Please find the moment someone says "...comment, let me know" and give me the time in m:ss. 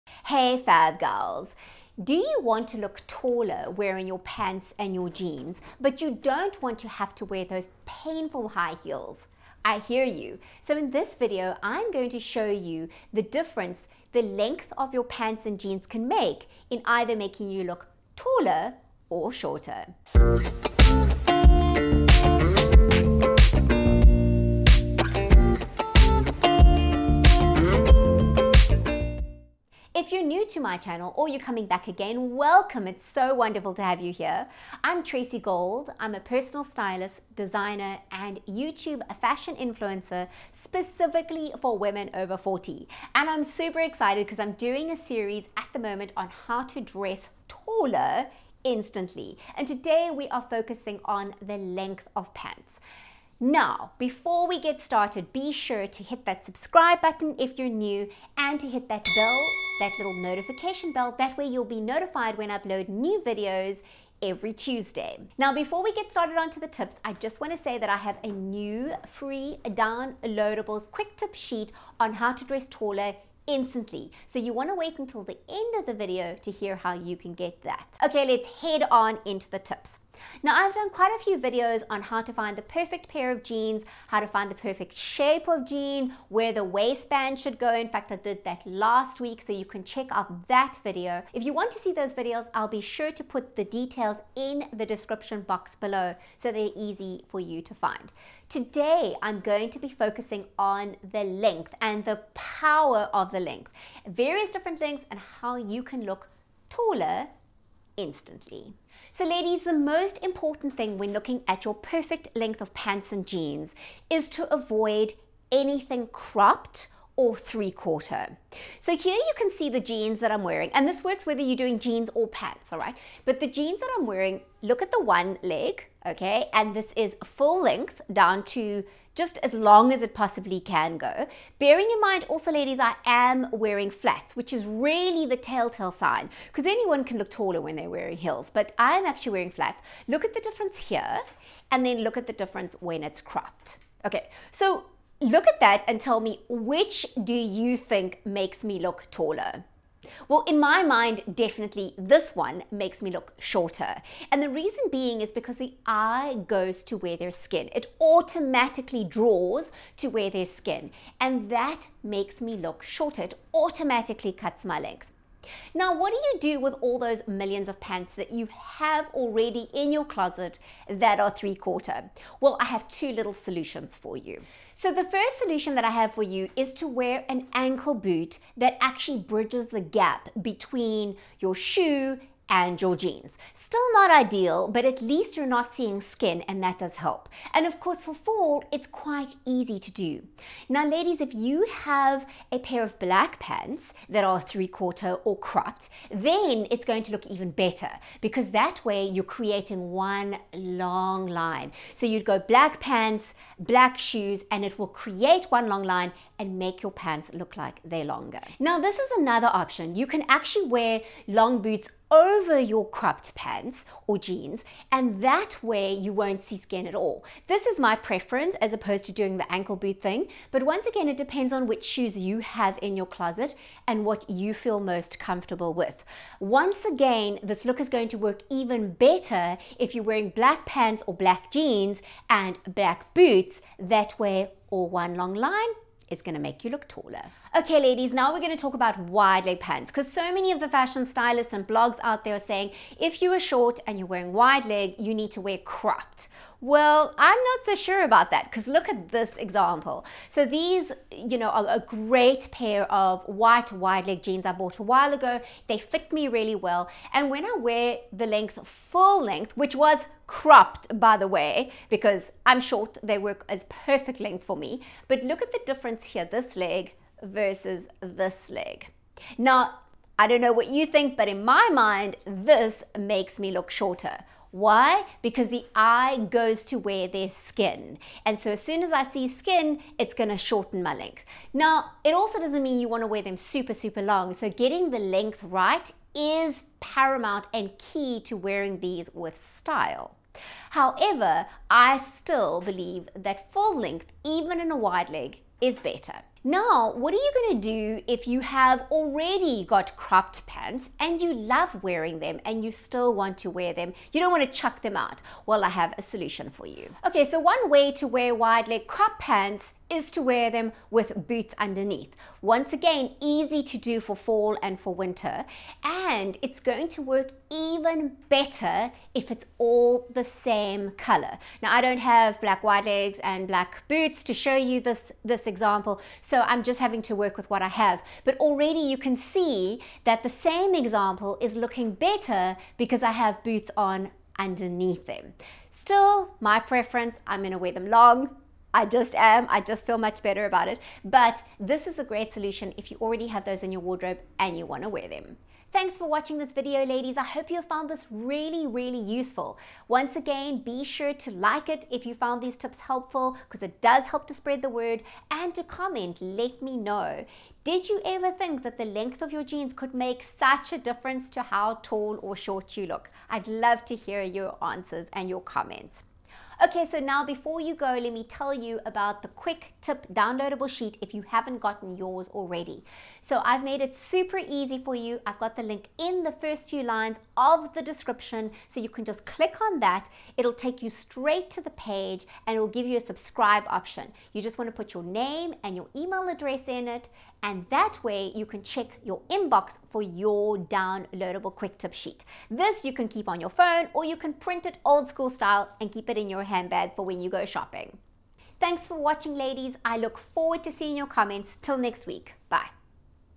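5:55.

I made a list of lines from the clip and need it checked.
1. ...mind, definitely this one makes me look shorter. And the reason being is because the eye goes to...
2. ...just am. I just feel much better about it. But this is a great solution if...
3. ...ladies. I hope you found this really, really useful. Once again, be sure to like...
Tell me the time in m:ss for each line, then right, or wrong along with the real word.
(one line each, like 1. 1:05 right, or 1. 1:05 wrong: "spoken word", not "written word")
1. 2:30 right
2. 5:38 right
3. 5:46 right.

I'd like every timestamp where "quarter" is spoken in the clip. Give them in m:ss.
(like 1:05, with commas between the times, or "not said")
1:57, 2:51, 3:14.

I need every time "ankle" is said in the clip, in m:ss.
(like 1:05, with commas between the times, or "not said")
2:57, 3:39.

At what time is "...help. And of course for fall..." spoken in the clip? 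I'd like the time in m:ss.
3:06.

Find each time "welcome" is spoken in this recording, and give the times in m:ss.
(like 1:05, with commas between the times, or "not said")
0:32.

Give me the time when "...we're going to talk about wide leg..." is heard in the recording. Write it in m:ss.
3:58.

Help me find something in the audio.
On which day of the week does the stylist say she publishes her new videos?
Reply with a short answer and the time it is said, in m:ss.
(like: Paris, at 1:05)
Tuesday, at 1:04.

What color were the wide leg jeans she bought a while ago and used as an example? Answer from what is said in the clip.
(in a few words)
White.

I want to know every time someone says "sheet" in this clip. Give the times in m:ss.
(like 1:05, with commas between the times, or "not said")
1:11, 6:10, 6:31.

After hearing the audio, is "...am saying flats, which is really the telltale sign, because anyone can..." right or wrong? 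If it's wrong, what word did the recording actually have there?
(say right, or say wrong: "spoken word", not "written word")
wrong: "wearing", not "saying".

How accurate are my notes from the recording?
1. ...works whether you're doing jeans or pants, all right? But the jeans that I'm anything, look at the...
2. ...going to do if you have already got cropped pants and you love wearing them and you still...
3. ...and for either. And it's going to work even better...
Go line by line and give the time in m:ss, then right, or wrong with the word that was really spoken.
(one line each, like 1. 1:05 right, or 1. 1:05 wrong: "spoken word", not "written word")
1. 2:01 wrong: "wearing", not "anything"
2. 4:57 right
3. 5:14 wrong: "winter", not "either".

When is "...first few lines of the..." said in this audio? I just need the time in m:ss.
6:16.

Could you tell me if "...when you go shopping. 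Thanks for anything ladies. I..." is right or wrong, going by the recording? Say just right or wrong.
wrong.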